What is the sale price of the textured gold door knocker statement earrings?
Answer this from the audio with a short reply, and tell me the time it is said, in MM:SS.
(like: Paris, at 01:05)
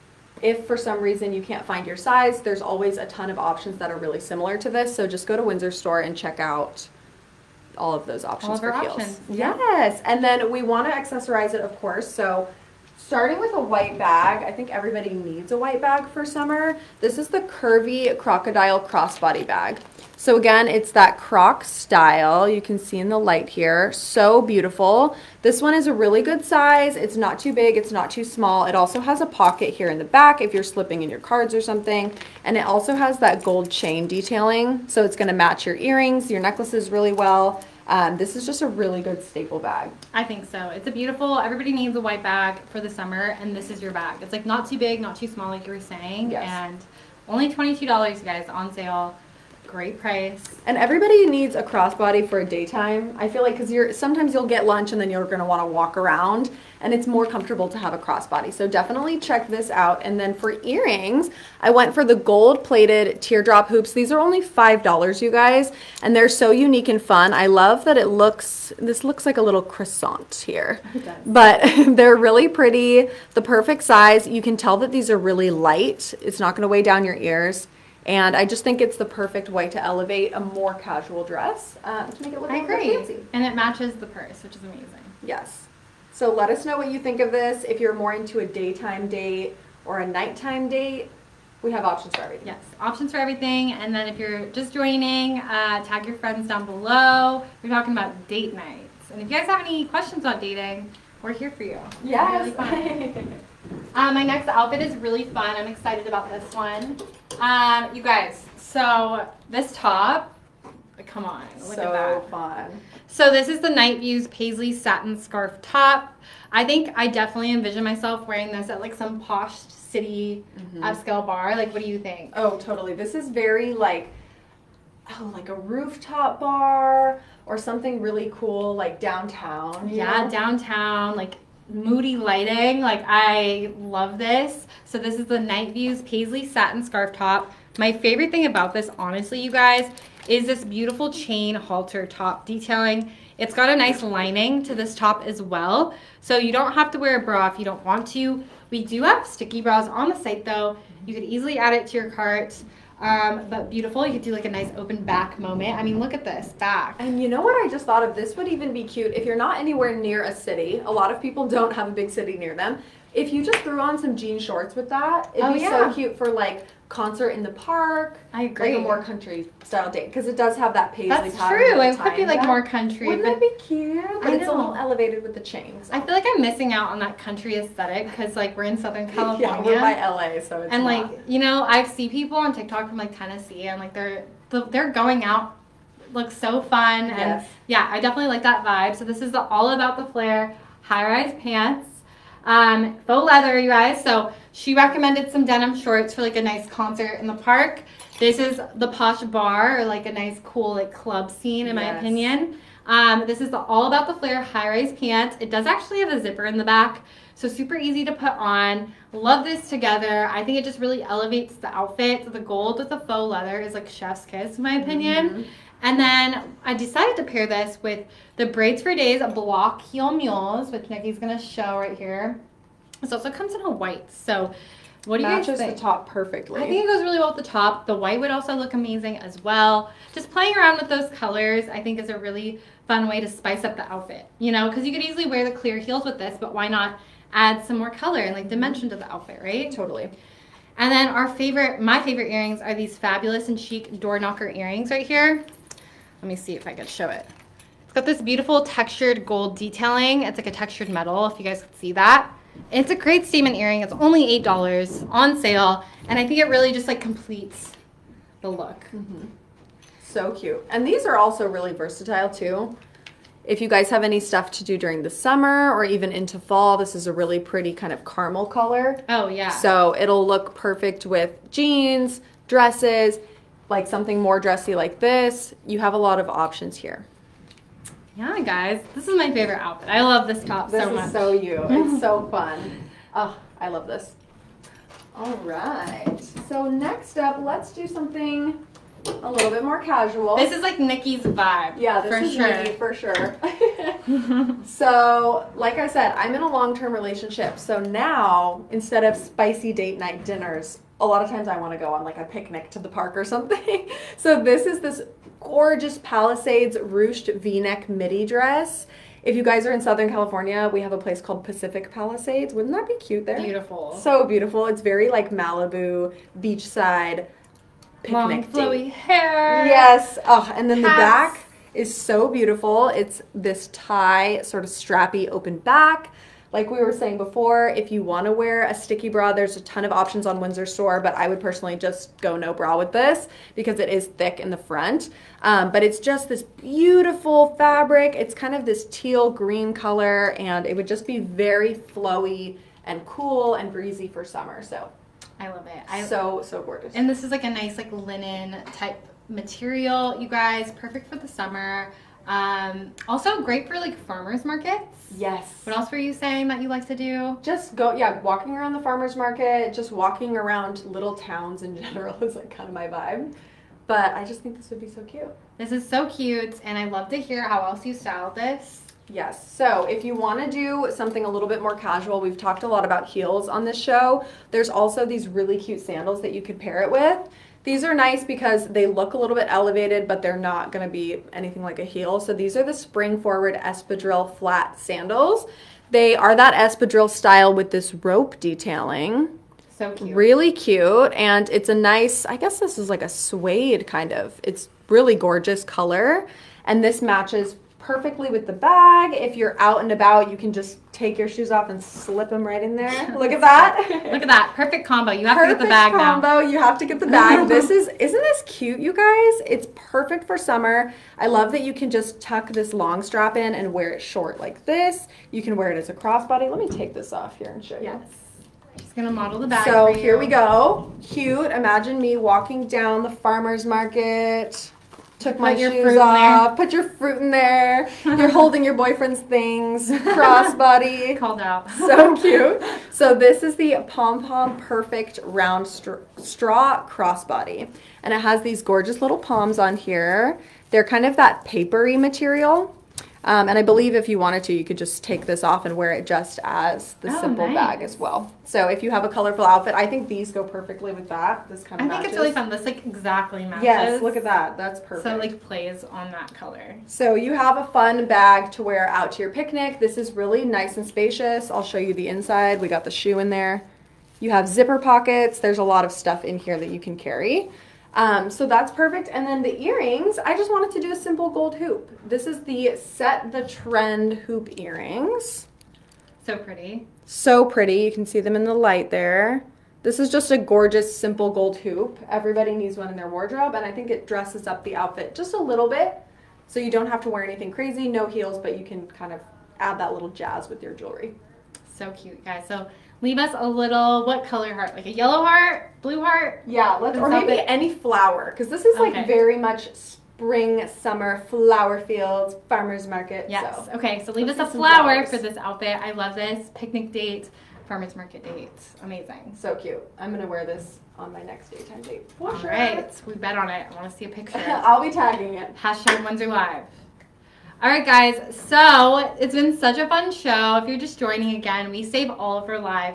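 $8, at 04:14.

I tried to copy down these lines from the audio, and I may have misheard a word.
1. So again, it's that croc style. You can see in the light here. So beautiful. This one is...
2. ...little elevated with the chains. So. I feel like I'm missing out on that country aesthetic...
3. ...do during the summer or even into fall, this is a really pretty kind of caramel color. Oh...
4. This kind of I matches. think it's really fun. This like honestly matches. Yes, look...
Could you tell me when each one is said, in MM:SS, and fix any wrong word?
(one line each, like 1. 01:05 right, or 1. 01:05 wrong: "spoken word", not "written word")
1. 00:20 right
2. 02:54 right
3. 04:24 right
4. 07:31 wrong: "exactly", not "honestly".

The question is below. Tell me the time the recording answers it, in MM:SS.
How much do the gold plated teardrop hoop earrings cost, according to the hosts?
01:04.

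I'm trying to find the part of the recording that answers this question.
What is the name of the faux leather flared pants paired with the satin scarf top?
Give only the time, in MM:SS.
03:09.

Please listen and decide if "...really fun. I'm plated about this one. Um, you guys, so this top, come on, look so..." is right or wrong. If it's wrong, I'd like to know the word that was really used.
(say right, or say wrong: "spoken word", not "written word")
wrong: "excited", not "plated".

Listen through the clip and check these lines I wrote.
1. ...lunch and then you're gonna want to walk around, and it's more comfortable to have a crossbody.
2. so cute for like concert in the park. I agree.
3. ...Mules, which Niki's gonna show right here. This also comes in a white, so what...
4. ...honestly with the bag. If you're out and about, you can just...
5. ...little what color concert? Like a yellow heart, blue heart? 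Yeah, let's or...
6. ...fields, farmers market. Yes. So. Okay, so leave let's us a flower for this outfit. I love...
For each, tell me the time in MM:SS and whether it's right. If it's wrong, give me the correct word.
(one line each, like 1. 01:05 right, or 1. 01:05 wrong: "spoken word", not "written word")
1. 00:54 right
2. 02:45 right
3. 03:40 right
4. 06:37 wrong: "perfectly", not "honestly"
5. 08:13 wrong: "heart", not "concert"
6. 08:21 right.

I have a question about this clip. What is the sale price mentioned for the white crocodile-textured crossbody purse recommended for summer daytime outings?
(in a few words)
$22.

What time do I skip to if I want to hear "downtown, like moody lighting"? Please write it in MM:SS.
02:10.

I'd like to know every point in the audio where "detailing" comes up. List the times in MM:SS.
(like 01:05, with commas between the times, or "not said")
00:34, 02:22, 04:09, 06:28.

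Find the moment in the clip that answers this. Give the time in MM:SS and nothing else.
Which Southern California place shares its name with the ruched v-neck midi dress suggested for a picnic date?
05:11.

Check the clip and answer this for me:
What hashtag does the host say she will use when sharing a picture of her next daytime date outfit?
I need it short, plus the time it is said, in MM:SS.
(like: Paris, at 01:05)
Windsor Live, at 08:36.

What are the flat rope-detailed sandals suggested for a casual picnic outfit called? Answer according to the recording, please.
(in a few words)
Spring Forward Espadrille Flat Sandals.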